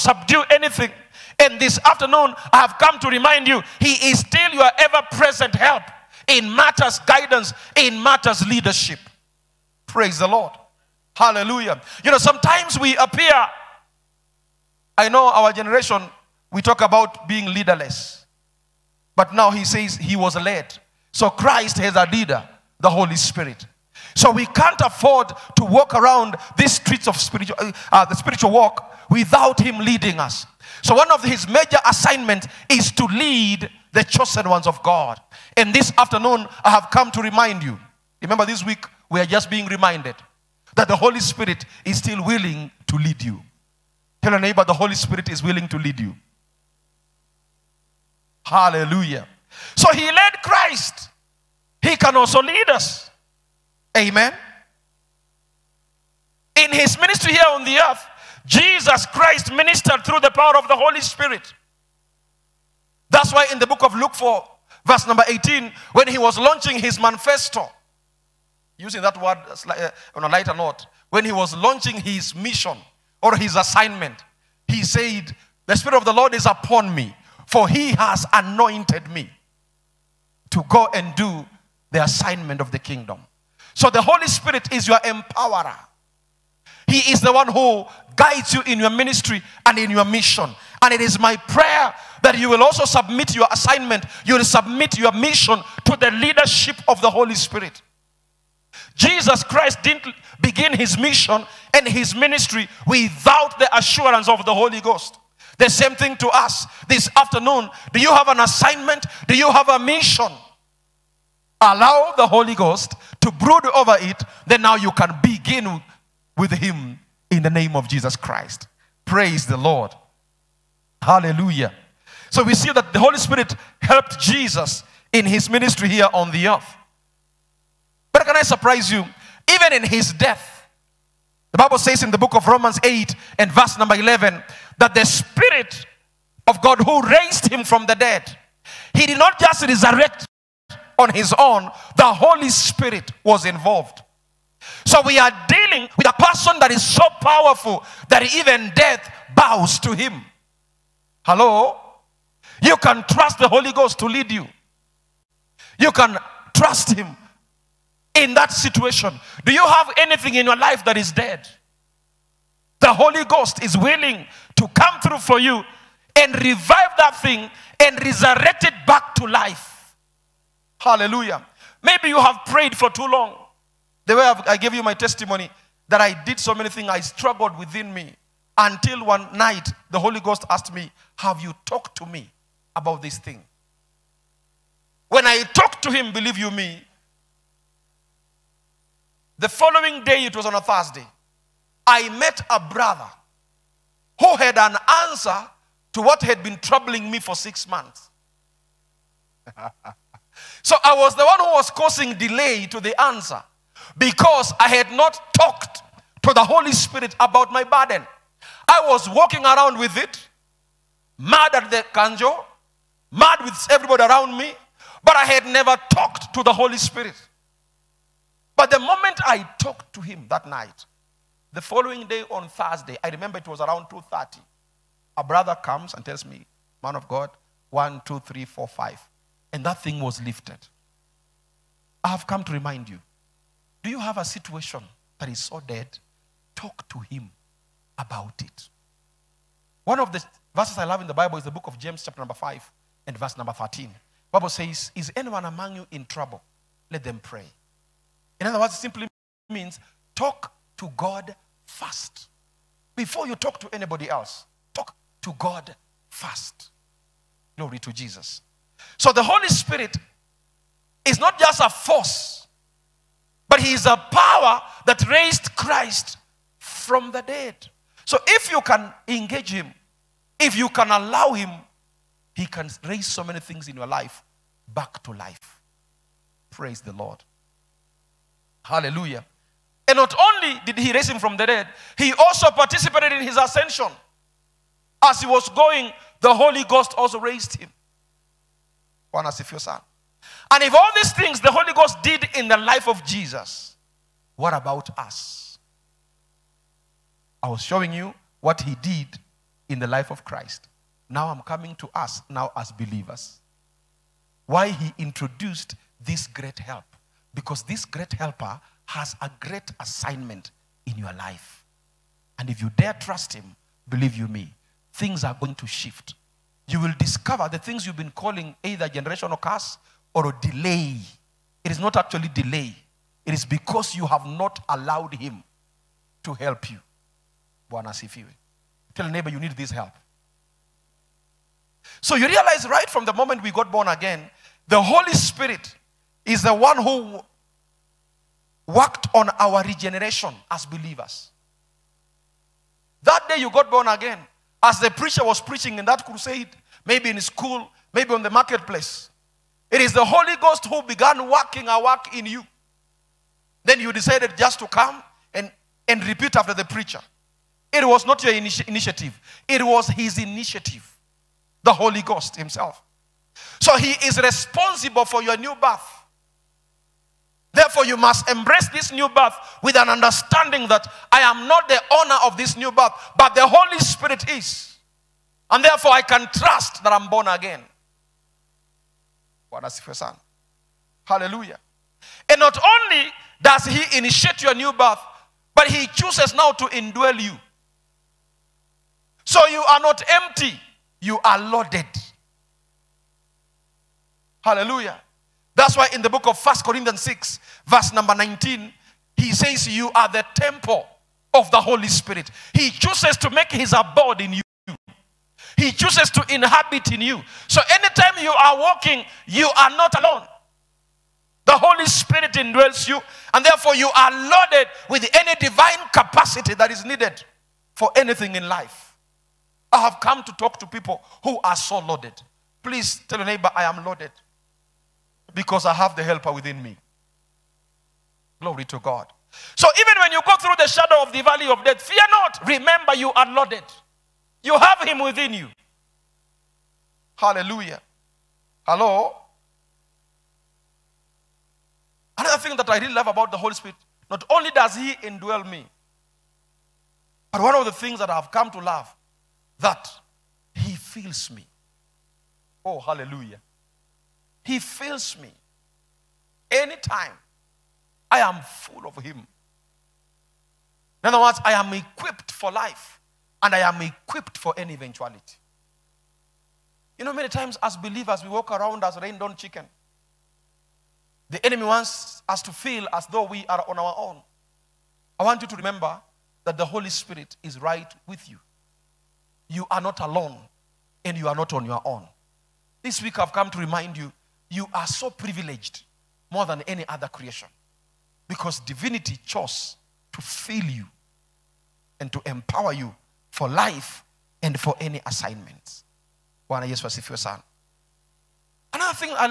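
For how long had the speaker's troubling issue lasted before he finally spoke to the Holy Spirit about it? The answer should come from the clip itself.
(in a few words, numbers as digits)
6 months.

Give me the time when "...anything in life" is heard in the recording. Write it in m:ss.
6:57.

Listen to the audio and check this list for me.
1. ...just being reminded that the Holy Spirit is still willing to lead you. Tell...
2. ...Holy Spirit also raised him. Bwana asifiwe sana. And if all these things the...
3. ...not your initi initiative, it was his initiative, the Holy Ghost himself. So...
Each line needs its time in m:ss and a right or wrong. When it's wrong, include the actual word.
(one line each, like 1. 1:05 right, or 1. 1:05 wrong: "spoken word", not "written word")
1. 0:39 right
2. 4:46 wrong: "Ghost", not "Spirit"
3. 5:58 right.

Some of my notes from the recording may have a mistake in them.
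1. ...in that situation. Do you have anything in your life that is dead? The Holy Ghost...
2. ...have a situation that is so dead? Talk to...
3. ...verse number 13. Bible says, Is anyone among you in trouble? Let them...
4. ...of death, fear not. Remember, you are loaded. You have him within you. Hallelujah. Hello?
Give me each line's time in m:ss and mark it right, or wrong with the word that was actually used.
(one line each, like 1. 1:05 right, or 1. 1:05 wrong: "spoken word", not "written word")
1. 2:38 right
2. 3:53 right
3. 4:03 right
4. 7:11 right.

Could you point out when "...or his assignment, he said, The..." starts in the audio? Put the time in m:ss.
1:13.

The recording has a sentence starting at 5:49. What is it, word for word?
It is the Holy Ghost who began working a work in you.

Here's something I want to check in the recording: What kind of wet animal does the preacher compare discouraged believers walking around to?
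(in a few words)
rained on chicken.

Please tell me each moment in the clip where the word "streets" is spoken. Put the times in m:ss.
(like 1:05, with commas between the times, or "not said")
0:26.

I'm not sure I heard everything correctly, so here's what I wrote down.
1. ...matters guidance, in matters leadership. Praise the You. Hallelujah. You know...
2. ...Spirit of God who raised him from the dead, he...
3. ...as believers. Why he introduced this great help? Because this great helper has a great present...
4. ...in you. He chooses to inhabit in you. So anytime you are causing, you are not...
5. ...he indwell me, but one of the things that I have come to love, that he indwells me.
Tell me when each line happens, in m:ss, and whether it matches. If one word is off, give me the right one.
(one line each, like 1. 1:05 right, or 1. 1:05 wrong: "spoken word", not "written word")
1. 0:06 wrong: "Lord", not "You"
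2. 2:15 right
3. 5:02 wrong: "assignment", not "present"
4. 6:44 wrong: "walking", not "causing"
5. 7:24 wrong: "fills", not "indwells".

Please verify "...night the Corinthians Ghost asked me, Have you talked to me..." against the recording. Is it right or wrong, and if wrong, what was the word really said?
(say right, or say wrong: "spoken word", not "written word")
wrong: "Holy", not "Corinthians".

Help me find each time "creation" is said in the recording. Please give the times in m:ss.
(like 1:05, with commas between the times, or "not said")
8:07.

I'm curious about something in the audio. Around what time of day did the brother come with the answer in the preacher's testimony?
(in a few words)
2:30.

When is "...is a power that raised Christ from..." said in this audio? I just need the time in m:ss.
4:23.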